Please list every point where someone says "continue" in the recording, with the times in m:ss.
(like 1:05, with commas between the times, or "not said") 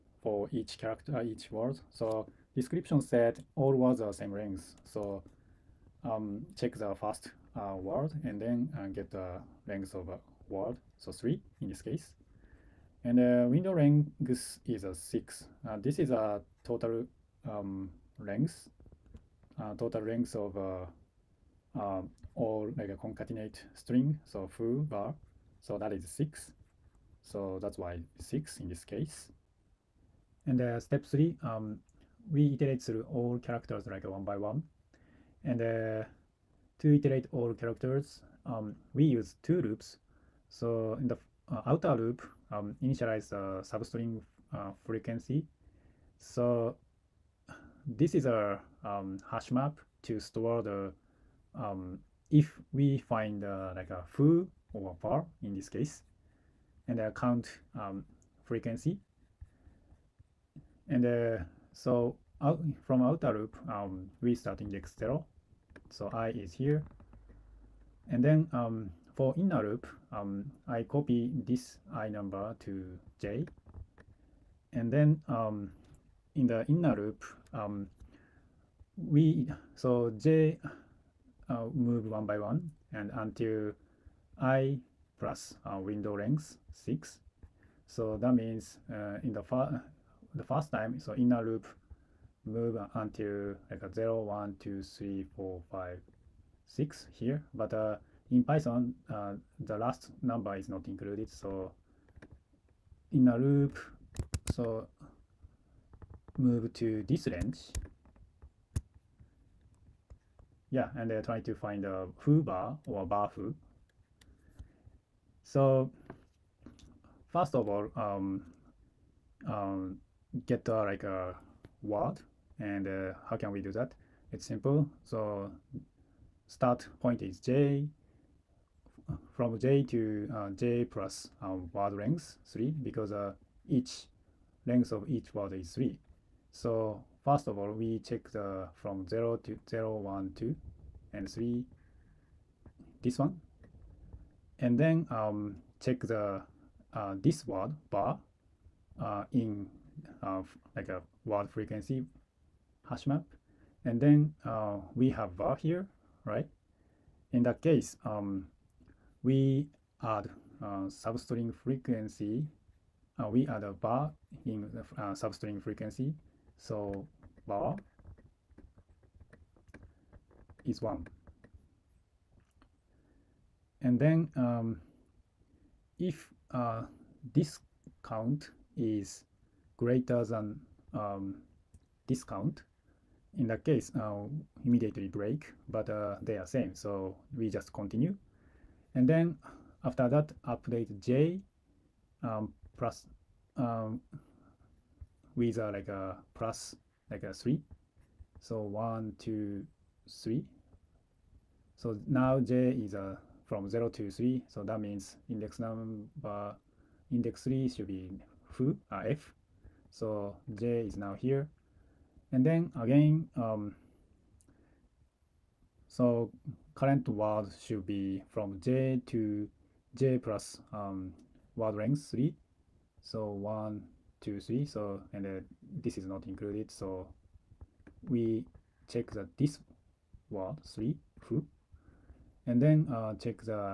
3:07.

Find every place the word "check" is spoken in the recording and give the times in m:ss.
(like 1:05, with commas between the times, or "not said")
0:06, 2:18, 2:25, 3:48, 3:53.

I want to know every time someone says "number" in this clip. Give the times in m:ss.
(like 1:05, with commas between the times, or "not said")
1:12, 1:40, 3:25.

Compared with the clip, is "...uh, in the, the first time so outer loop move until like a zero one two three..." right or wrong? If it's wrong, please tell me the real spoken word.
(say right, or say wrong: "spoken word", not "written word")
wrong: "inner", not "outer".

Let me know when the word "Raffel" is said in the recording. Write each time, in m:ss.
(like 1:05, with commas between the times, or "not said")
not said.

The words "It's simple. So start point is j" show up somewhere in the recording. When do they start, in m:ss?
2:04.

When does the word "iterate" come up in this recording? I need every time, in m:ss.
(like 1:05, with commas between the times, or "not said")
0:32, 0:36.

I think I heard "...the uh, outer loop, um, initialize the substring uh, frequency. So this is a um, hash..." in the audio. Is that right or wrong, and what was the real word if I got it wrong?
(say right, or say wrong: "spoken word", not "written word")
right.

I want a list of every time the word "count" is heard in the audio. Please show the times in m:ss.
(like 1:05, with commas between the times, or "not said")
0:57, 2:58, 3:02.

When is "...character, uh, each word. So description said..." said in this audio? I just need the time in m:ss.
0:00.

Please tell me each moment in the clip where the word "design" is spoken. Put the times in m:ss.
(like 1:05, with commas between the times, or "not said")
not said.